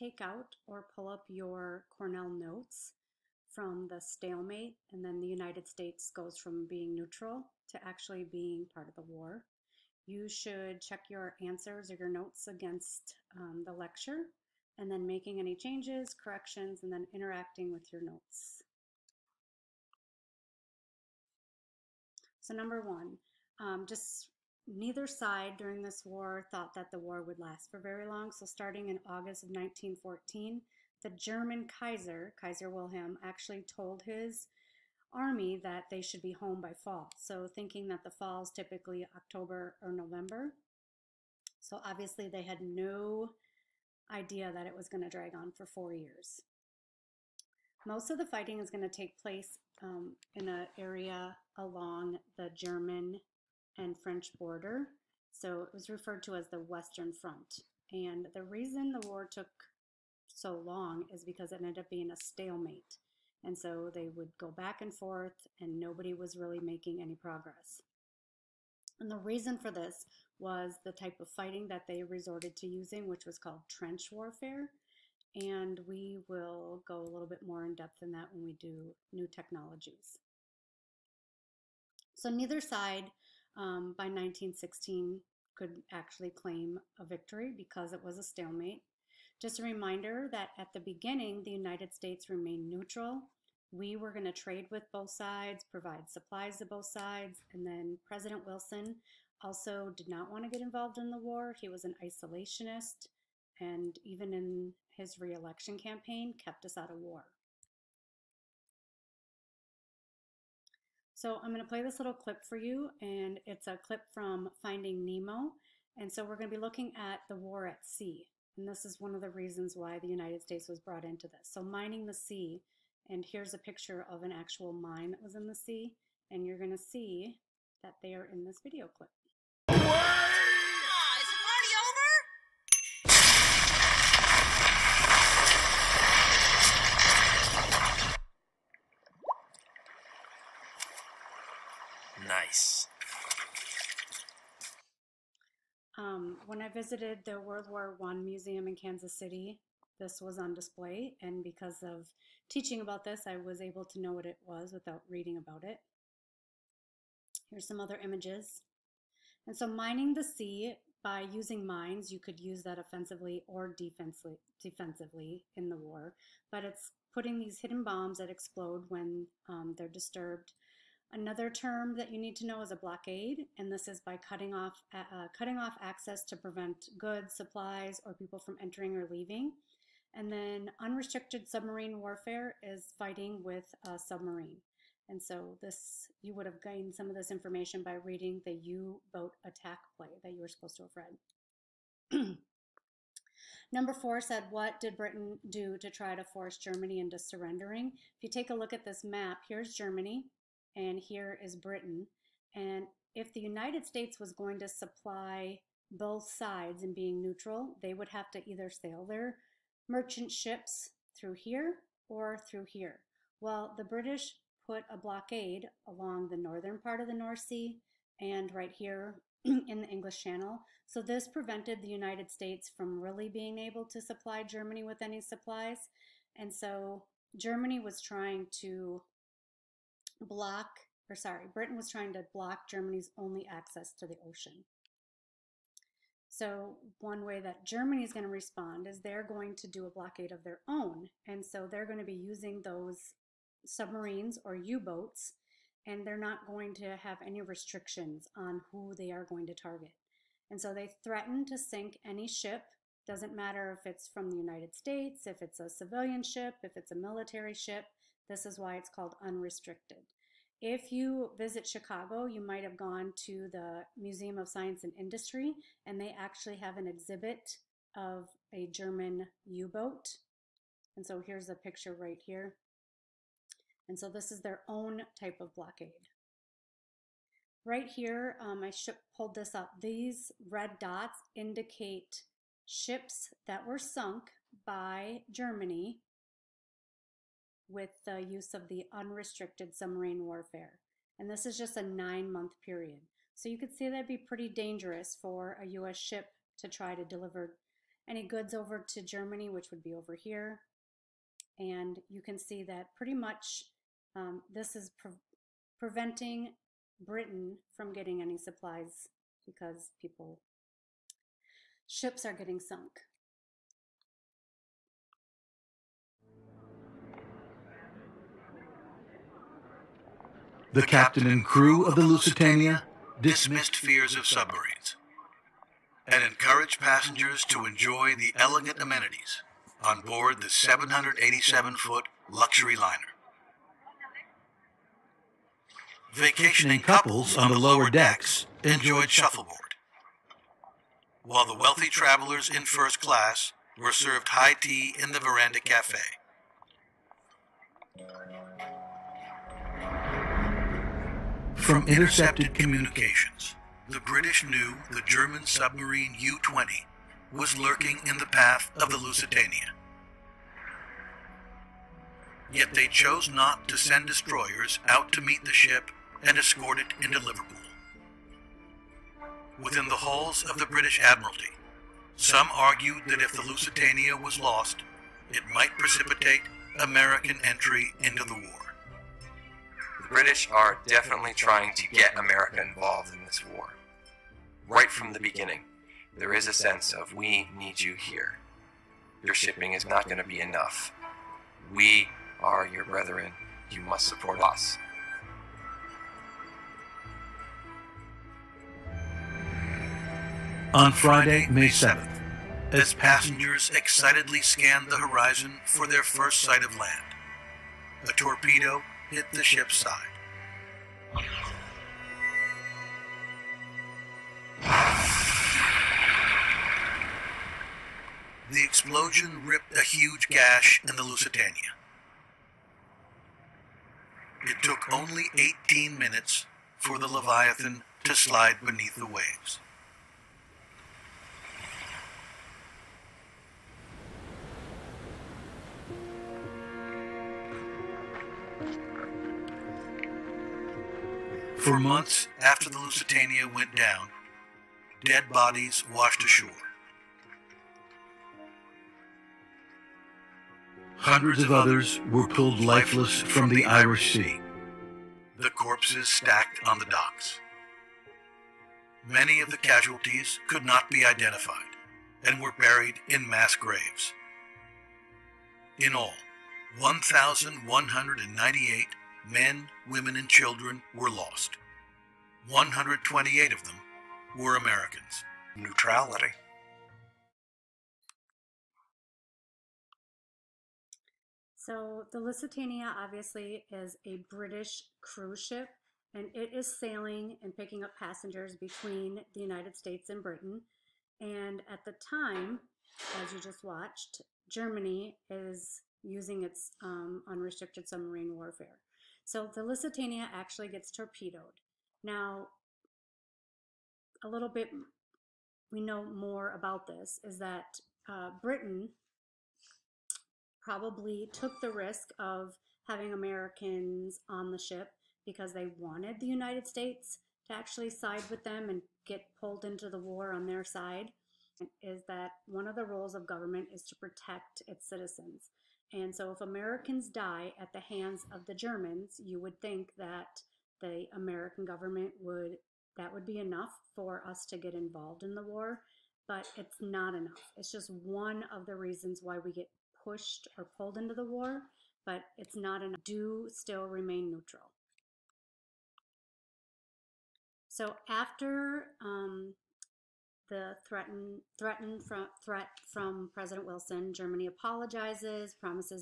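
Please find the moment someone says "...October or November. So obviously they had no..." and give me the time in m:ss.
0:39.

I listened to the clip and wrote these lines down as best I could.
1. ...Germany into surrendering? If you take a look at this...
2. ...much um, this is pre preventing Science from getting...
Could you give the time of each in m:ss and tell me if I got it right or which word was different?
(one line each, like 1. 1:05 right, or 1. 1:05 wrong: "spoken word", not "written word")
1. 3:16 right
2. 5:03 wrong: "Britain", not "Science".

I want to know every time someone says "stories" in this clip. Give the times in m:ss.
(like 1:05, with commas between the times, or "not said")
not said.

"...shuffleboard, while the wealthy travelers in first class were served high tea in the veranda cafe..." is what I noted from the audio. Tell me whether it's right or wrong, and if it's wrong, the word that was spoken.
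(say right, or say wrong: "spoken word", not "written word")
right.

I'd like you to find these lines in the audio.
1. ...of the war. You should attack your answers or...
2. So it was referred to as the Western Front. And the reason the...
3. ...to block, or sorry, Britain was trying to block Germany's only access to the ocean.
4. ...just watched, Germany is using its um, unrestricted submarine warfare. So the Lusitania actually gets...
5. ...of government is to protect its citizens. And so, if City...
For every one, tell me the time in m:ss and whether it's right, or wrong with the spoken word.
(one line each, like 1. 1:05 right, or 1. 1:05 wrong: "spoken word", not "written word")
1. 0:08 wrong: "check", not "attack"
2. 0:55 right
3. 3:48 right
4. 8:13 right
5. 8:43 wrong: "Americans", not "City".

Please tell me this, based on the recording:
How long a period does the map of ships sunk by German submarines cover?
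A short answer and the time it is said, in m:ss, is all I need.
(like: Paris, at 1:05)
9 months, at 4:51.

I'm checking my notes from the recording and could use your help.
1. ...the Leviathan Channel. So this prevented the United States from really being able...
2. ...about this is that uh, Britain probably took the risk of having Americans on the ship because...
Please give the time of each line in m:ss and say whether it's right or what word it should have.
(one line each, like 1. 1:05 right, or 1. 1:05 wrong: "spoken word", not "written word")
1. 3:39 wrong: "English", not "Leviathan"
2. 8:26 right.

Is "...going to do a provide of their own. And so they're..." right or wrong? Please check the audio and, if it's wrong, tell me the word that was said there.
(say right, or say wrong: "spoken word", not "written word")
wrong: "blockade", not "provide".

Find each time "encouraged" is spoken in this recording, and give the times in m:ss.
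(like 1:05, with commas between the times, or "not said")
5:26.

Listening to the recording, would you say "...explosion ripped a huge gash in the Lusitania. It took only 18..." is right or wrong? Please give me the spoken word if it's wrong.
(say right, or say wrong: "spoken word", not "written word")
right.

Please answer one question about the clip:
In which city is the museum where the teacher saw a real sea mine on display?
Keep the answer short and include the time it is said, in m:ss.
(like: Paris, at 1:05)
Kansas City, at 2:28.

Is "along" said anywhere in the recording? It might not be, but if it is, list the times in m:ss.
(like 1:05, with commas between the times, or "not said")
0:51, 3:35.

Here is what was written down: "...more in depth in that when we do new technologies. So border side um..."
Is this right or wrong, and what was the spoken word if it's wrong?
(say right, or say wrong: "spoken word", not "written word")
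wrong: "neither", not "border".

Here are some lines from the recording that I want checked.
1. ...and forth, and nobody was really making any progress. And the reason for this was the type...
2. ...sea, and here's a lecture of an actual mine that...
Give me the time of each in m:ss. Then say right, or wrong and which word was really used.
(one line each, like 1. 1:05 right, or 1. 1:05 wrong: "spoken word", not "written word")
1. 1:04 right
2. 2:02 wrong: "picture", not "lecture".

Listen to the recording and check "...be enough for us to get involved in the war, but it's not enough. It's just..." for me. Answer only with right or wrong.
right.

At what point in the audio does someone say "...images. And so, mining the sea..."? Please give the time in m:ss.
2:38.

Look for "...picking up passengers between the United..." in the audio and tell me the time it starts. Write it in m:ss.
8:07.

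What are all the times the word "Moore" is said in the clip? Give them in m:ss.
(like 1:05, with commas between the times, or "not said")
not said.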